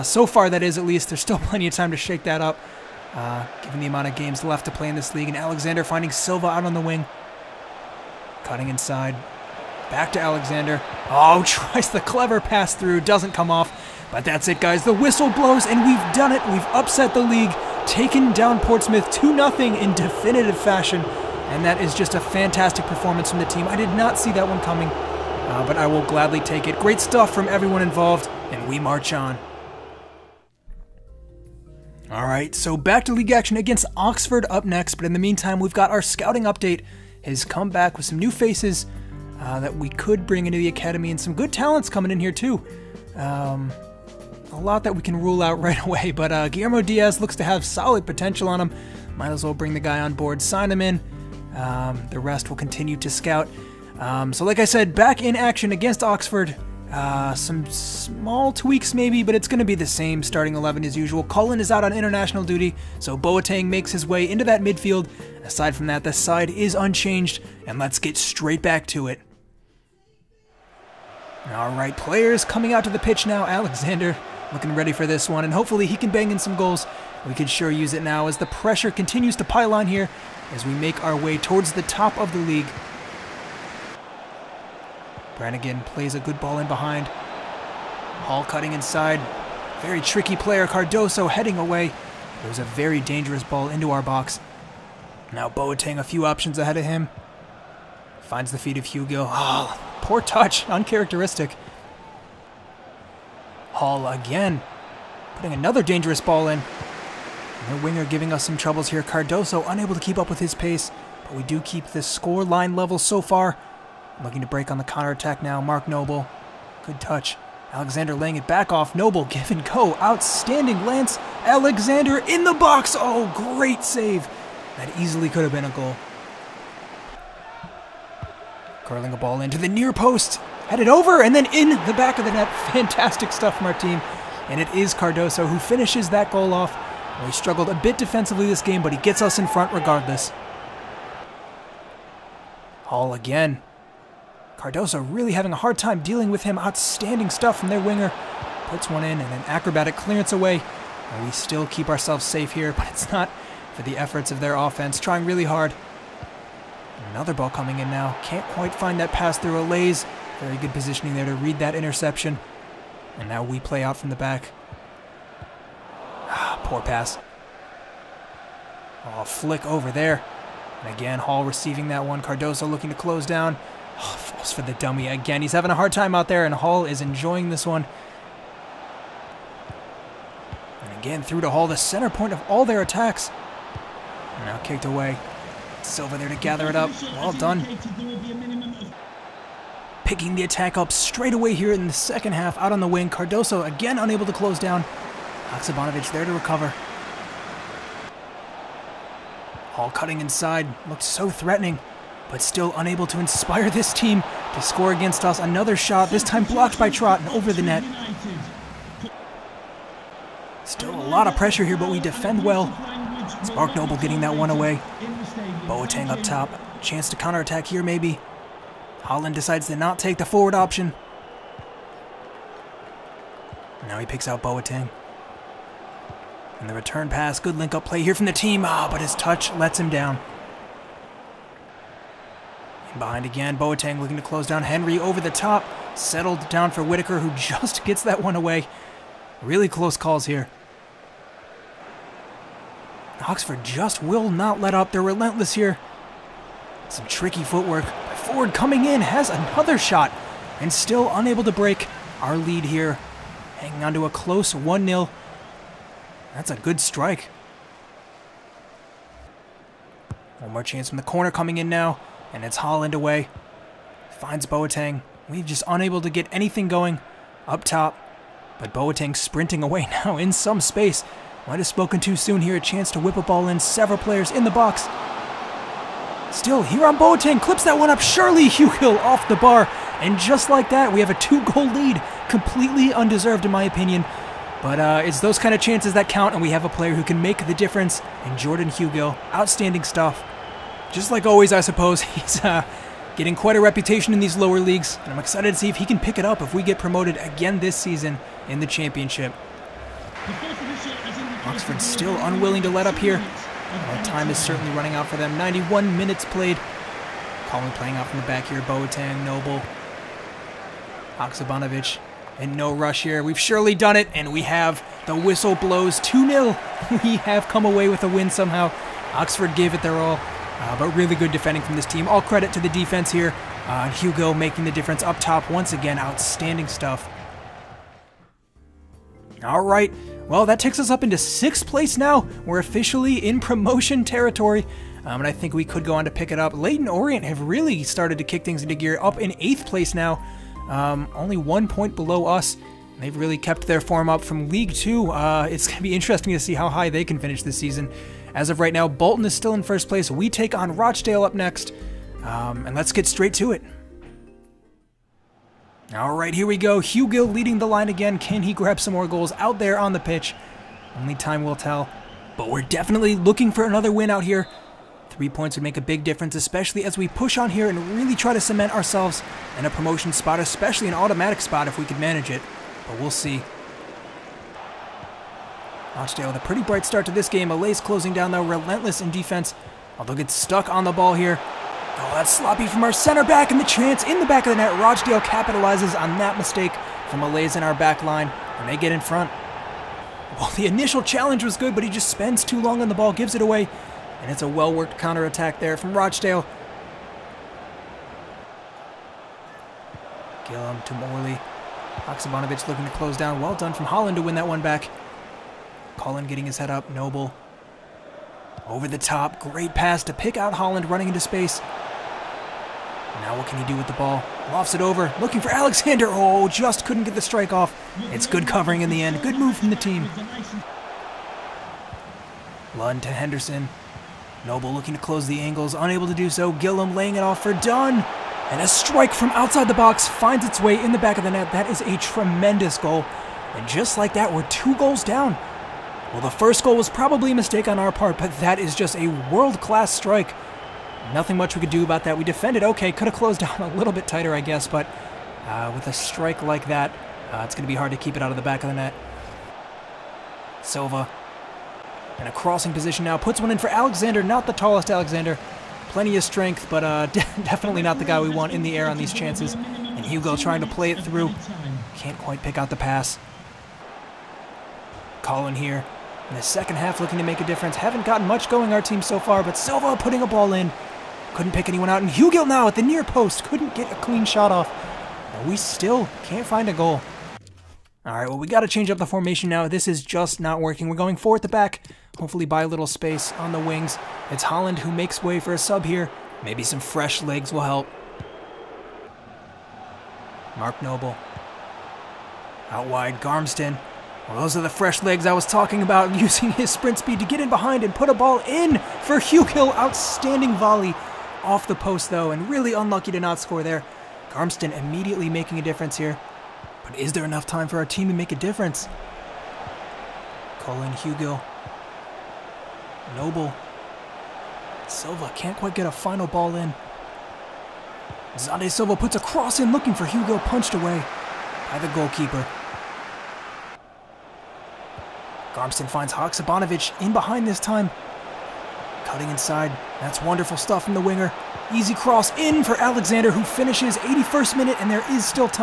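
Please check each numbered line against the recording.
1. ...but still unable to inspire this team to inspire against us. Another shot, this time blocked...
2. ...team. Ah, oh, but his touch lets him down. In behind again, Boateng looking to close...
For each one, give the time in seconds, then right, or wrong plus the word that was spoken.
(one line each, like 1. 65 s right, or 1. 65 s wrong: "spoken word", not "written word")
1. 202 s wrong: "score", not "inspire"
2. 228 s right.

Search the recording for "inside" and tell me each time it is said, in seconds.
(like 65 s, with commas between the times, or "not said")
8 s, 88 s, 200 s, 529 s.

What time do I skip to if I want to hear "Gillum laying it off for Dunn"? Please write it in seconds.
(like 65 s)
426 s.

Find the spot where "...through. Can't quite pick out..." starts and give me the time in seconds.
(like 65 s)
461 s.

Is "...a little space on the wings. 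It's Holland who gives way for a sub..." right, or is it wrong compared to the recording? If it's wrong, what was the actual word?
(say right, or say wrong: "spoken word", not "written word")
wrong: "makes", not "gives".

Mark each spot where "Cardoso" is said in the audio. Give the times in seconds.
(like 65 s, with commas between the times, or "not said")
90 s, 109 s, 134 s, 144 s, 172 s, 193 s.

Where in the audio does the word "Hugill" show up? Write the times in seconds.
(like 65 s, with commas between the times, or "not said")
278 s, 288 s, 356 s, 472 s.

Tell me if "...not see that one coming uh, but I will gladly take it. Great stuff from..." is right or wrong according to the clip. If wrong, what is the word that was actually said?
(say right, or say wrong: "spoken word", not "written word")
right.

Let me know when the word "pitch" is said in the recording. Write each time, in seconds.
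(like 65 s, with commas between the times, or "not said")
72 s, 359 s.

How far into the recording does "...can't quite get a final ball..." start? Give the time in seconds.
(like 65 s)
515 s.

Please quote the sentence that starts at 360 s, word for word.
Only time will tell, but we're definitely looking for another win out here.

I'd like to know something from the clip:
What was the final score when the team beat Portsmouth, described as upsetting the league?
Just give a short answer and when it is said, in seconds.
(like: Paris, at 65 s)
2-0, at 19 s.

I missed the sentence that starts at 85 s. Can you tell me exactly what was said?
Brannigan plays a good ball in behind.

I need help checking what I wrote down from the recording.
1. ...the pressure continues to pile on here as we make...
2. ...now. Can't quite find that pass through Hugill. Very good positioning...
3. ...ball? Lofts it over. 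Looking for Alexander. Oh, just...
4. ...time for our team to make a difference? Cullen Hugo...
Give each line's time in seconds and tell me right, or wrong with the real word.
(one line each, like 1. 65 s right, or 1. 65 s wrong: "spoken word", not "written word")
1. 78 s right
2. 157 s wrong: "Alese", not "Hugill"
3. 413 s right
4. 507 s right.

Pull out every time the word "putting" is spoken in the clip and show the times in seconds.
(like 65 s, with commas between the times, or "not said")
105 s, 469 s.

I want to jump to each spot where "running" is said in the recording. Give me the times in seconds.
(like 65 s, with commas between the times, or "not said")
304 s, 410 s.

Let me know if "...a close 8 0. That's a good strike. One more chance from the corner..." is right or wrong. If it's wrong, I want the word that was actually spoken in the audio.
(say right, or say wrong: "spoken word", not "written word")
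wrong: "1", not "8".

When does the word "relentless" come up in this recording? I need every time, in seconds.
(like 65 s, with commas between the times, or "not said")
245 s, 378 s.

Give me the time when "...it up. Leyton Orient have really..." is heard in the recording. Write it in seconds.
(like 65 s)
336 s.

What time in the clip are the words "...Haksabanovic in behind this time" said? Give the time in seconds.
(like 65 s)
526 s.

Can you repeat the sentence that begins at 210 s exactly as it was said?
Still a lot of pressure here, but we defend well.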